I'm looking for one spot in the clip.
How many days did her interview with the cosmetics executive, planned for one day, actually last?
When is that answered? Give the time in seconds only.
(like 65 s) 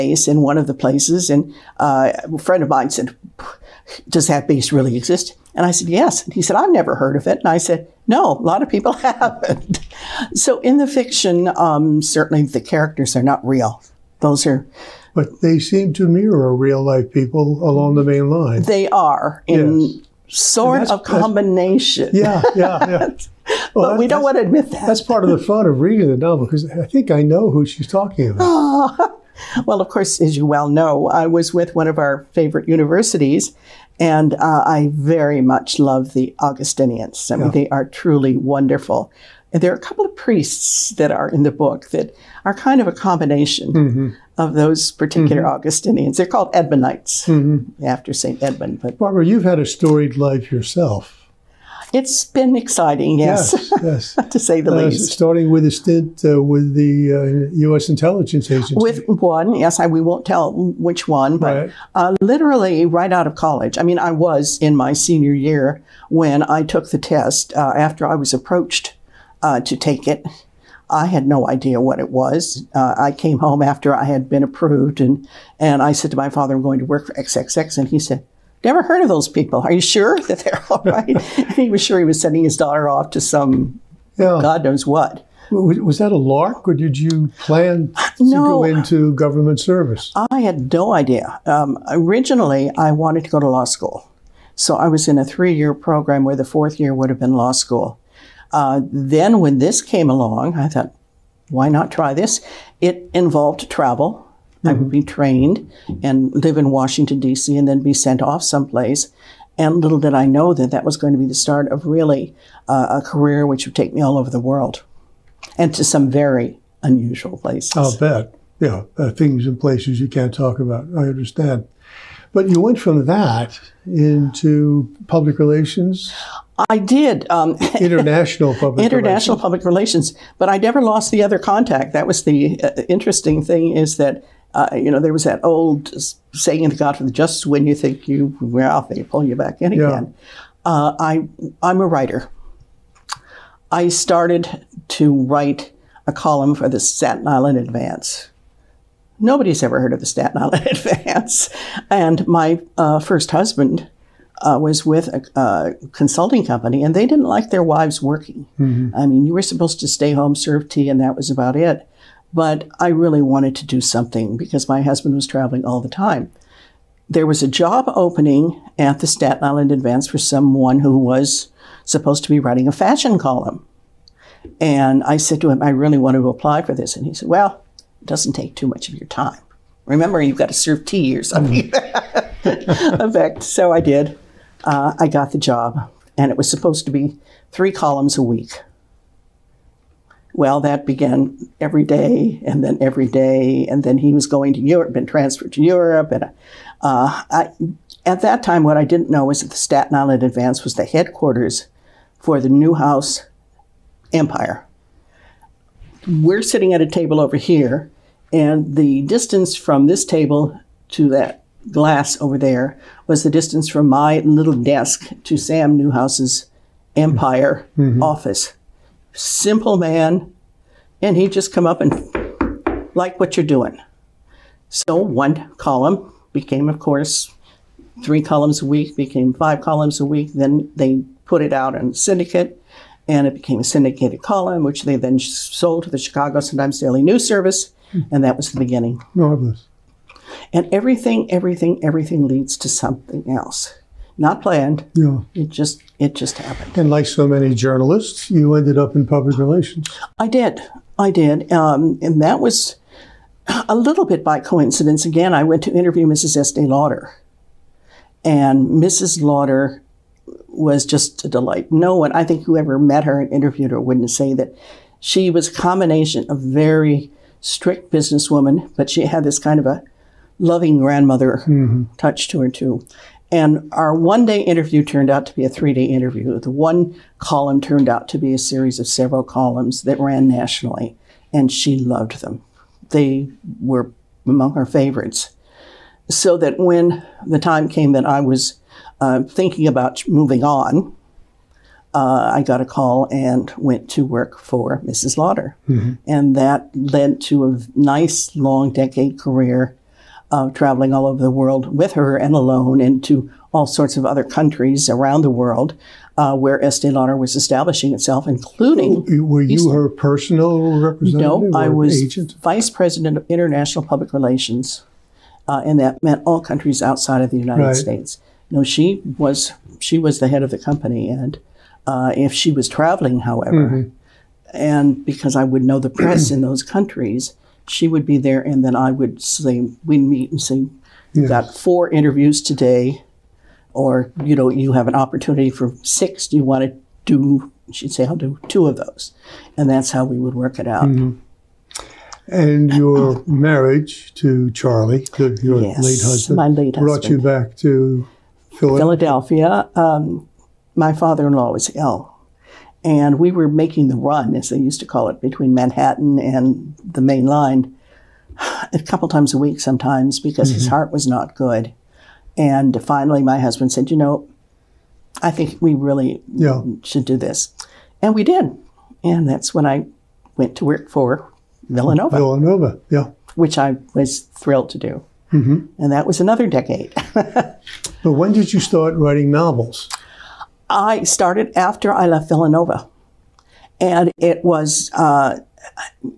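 275 s.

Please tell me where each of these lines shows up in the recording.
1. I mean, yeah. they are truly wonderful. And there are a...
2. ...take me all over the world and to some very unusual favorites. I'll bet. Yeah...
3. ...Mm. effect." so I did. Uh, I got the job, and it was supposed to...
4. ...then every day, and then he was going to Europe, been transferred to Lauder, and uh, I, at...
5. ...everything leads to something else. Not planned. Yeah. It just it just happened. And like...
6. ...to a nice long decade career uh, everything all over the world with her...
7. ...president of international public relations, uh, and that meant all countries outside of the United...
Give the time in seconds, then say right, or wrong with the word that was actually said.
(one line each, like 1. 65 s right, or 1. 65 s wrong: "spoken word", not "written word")
1. 37 s right
2. 113 s wrong: "places", not "favorites"
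3. 182 s right
4. 192 s wrong: "Europe", not "Lauder"
5. 241 s right
6. 297 s wrong: "traveling", not "everything"
7. 312 s right.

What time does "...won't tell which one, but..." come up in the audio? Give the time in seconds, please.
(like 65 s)
60 s.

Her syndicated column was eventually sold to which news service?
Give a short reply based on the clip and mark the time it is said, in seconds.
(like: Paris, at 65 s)
Chicago Sun-Times Daily News Service, at 235 s.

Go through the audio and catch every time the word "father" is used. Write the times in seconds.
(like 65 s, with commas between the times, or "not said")
76 s, 350 s.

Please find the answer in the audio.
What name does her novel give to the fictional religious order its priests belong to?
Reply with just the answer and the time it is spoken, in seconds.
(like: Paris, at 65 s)
Edmundites, at 46 s.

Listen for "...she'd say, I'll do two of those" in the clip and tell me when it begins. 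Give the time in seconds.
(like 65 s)
337 s.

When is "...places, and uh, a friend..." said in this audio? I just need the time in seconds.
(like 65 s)
0 s.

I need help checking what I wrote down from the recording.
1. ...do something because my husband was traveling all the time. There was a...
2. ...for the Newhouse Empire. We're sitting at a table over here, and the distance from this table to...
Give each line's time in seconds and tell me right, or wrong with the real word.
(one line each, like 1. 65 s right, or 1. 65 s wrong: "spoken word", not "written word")
1. 163 s right
2. 202 s right.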